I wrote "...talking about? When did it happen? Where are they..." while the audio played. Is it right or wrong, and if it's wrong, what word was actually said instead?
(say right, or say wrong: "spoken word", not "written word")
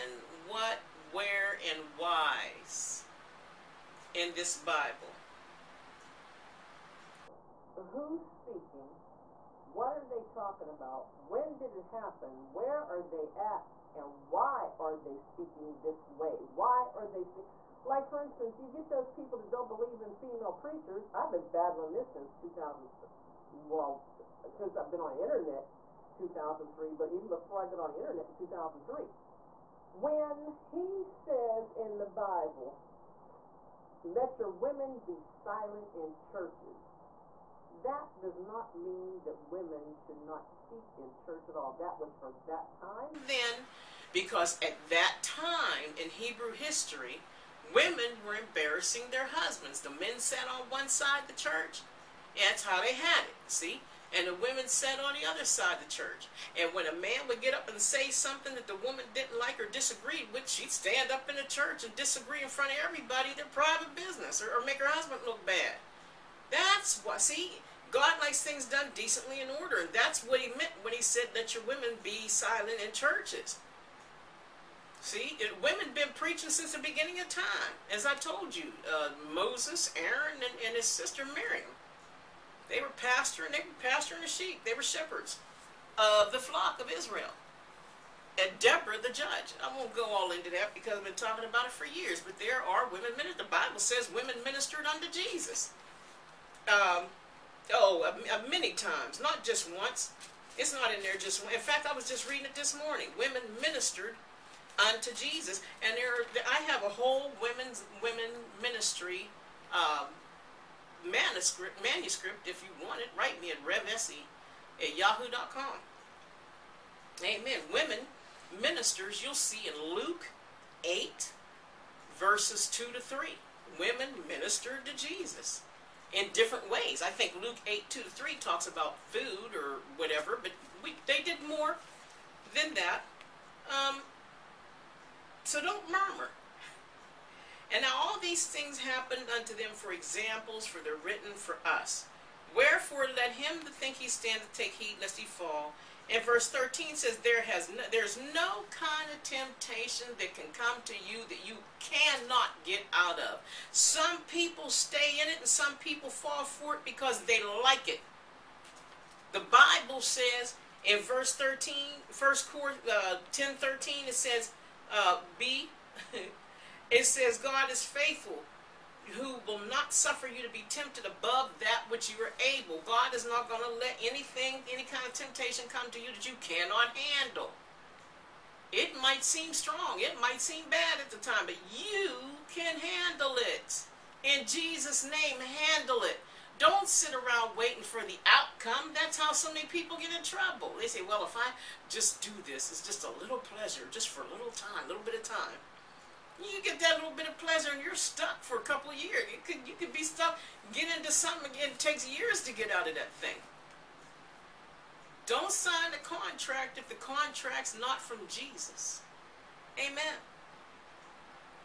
right.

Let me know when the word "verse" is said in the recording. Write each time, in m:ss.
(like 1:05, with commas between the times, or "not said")
2:02, 2:26, 2:40.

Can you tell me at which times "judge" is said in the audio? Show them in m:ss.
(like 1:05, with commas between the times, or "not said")
1:29.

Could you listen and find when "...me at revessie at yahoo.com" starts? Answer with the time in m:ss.
1:53.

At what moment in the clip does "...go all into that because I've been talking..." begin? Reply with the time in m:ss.
1:29.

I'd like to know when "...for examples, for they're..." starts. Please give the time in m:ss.
2:19.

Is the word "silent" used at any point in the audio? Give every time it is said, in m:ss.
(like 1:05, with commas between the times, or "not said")
0:35, 1:12.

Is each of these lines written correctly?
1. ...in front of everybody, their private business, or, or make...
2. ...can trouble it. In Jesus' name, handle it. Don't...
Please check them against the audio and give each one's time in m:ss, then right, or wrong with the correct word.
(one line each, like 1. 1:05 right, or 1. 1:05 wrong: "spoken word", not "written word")
1. 1:02 right
2. 3:02 wrong: "handle", not "trouble".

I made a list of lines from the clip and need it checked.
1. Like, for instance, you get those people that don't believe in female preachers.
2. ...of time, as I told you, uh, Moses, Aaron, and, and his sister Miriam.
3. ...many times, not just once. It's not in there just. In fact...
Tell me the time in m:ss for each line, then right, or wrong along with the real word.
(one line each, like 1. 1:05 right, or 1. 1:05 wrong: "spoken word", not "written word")
1. 0:17 right
2. 1:17 right
3. 1:38 right.